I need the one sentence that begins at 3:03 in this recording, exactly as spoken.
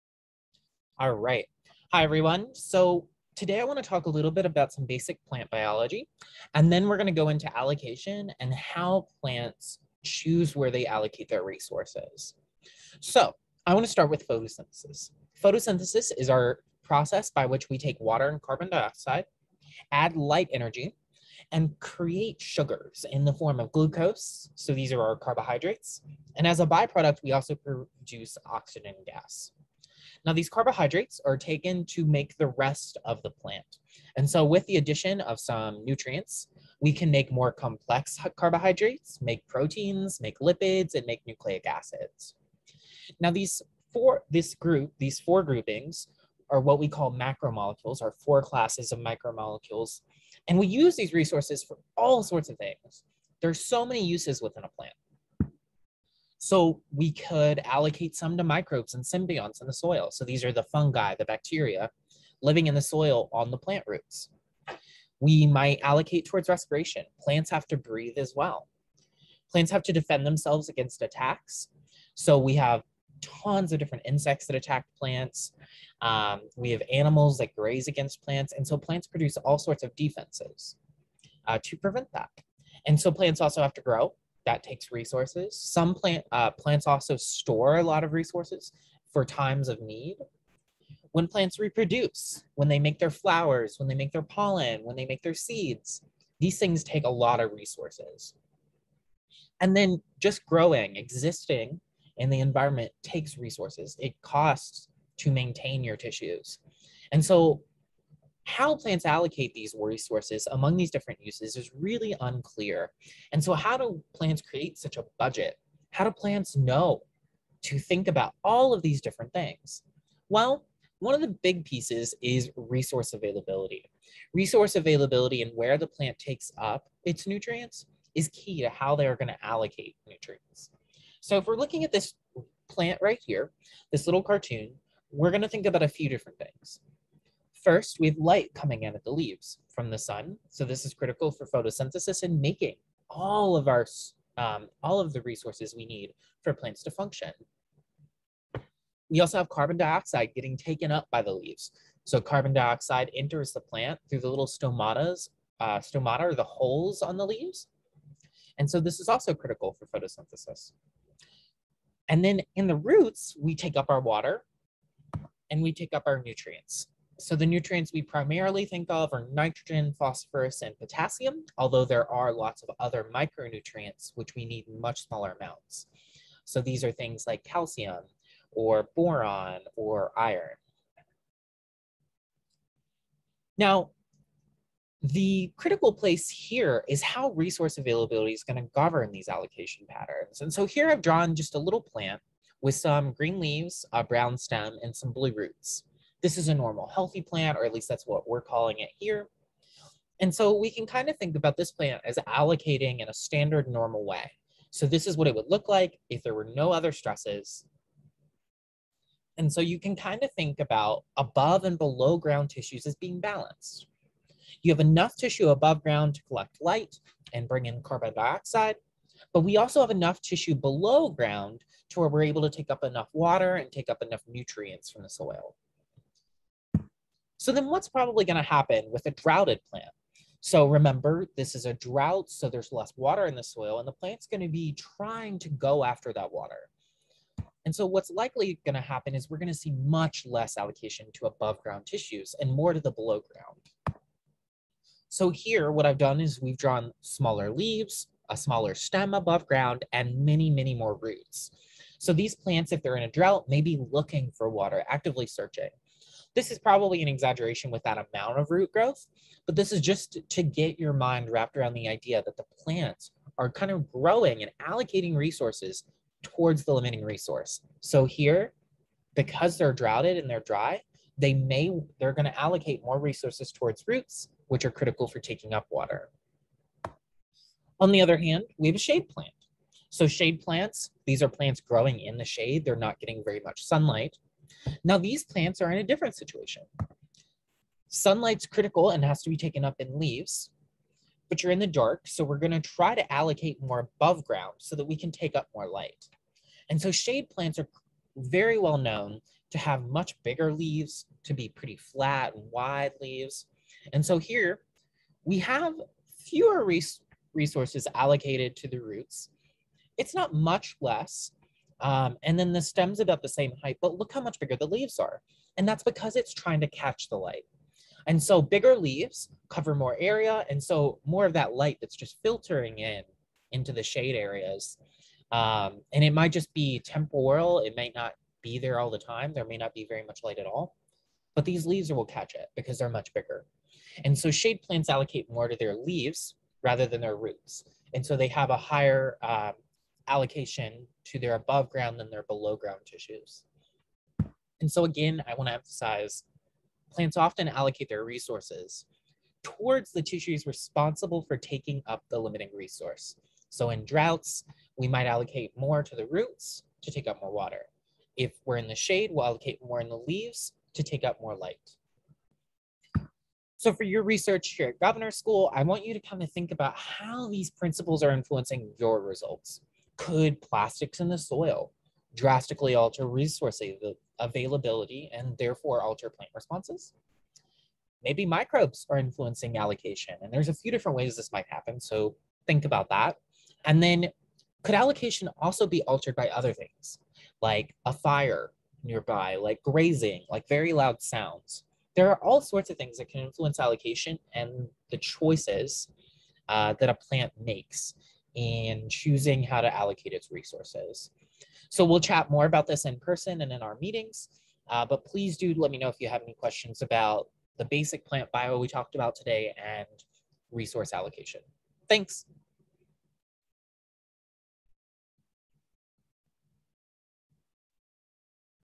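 Now, the critical place here is how resource availability is going to govern these allocation patterns.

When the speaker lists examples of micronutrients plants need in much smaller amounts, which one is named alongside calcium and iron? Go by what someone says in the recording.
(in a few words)
boron.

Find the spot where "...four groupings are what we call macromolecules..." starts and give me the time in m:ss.
0:45.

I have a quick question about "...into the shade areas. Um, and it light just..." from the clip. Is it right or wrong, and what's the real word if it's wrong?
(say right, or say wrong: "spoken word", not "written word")
wrong: "might", not "light".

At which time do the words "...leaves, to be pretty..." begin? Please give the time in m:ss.
5:00.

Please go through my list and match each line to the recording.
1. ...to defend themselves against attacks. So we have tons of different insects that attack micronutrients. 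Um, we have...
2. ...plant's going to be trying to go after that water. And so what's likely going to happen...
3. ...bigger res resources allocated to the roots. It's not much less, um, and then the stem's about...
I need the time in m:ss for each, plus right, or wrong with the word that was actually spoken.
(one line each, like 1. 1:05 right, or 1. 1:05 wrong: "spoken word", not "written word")
1. 1:09 wrong: "plants", not "micronutrients"
2. 3:53 right
3. 5:06 wrong: "fewer", not "bigger".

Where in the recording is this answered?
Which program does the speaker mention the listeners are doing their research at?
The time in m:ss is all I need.
6:04.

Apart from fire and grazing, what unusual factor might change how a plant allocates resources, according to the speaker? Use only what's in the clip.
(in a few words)
very loud sounds.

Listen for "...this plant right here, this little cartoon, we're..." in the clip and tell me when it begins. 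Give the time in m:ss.
2:11.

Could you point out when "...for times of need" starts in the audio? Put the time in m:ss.
1:29.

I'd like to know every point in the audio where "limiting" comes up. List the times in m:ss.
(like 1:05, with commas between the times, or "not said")
4:26, 5:52.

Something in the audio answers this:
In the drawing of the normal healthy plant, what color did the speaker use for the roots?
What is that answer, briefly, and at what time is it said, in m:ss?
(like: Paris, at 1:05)
blue, at 3:15.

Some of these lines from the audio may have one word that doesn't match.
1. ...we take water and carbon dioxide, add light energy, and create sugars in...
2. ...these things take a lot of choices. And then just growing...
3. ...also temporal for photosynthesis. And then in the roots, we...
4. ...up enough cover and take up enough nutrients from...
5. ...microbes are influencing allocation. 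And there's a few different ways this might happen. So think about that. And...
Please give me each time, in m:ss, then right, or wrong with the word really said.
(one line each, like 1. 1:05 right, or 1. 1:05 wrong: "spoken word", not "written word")
1. 0:17 right
2. 1:36 wrong: "resources", not "choices"
3. 2:39 wrong: "critical", not "temporal"
4. 3:42 wrong: "water", not "cover"
5. 6:18 right.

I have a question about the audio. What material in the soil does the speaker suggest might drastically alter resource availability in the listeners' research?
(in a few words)
plastics.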